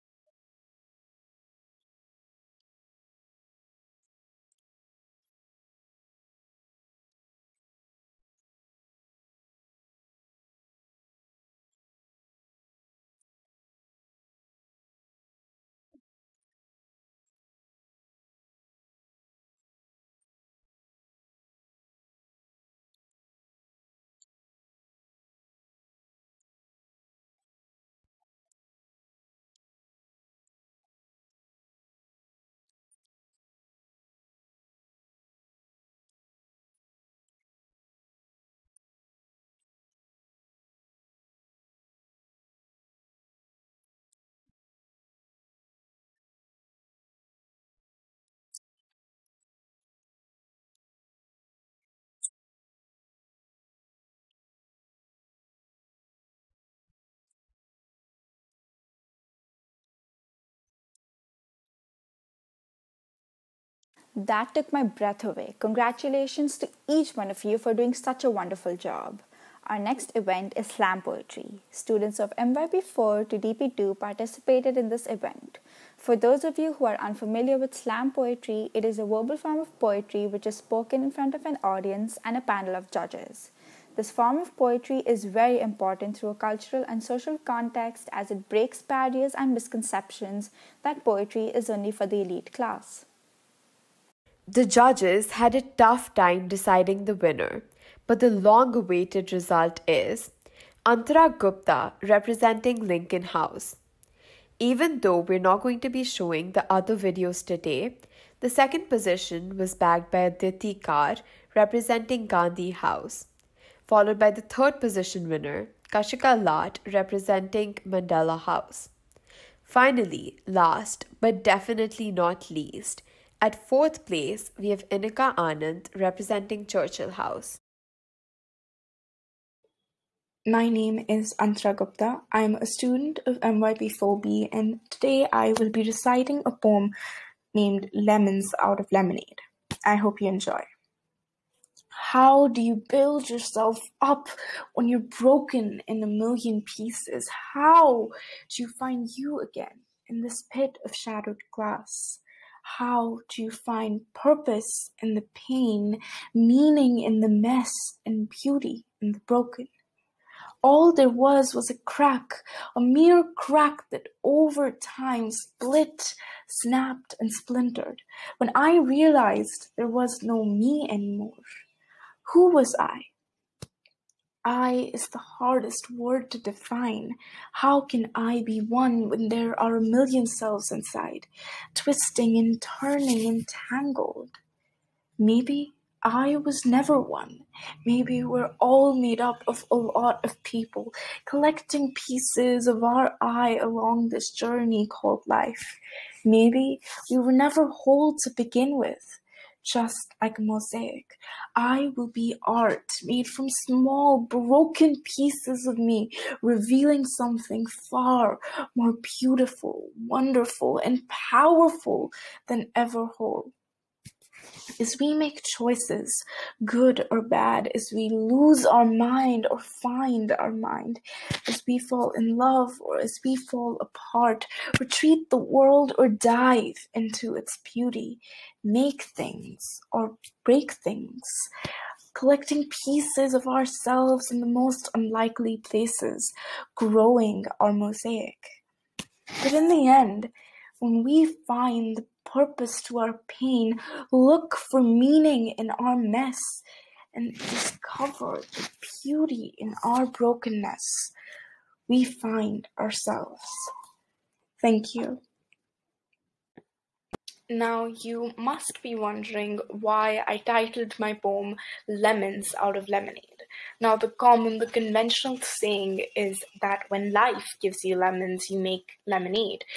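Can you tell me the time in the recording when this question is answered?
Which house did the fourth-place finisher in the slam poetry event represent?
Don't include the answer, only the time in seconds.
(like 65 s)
126 s.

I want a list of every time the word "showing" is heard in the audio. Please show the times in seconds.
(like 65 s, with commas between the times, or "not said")
106 s.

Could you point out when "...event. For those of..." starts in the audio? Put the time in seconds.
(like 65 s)
75 s.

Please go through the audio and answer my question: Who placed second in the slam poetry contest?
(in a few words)
Aditi Kar.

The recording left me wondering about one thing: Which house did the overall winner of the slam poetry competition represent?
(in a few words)
Lincoln House.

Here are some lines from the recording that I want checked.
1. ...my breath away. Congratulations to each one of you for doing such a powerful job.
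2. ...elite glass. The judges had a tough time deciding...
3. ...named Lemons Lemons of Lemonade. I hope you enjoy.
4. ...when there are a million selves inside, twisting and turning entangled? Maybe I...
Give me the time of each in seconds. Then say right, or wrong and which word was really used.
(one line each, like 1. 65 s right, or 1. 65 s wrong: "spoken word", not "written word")
1. 64 s wrong: "wonderful", not "powerful"
2. 92 s wrong: "class", not "glass"
3. 137 s wrong: "Out", not "Lemons"
4. 179 s right.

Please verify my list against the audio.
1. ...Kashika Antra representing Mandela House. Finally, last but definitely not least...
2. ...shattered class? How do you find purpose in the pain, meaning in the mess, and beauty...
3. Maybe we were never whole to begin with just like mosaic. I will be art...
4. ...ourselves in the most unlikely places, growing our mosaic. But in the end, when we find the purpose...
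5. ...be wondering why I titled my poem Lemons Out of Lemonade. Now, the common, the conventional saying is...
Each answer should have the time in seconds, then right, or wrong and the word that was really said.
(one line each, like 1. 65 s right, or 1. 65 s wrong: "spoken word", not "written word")
1. 115 s wrong: "Lat", not "Antra"
2. 150 s wrong: "glass", not "class"
3. 196 s right
4. 233 s right
5. 258 s right.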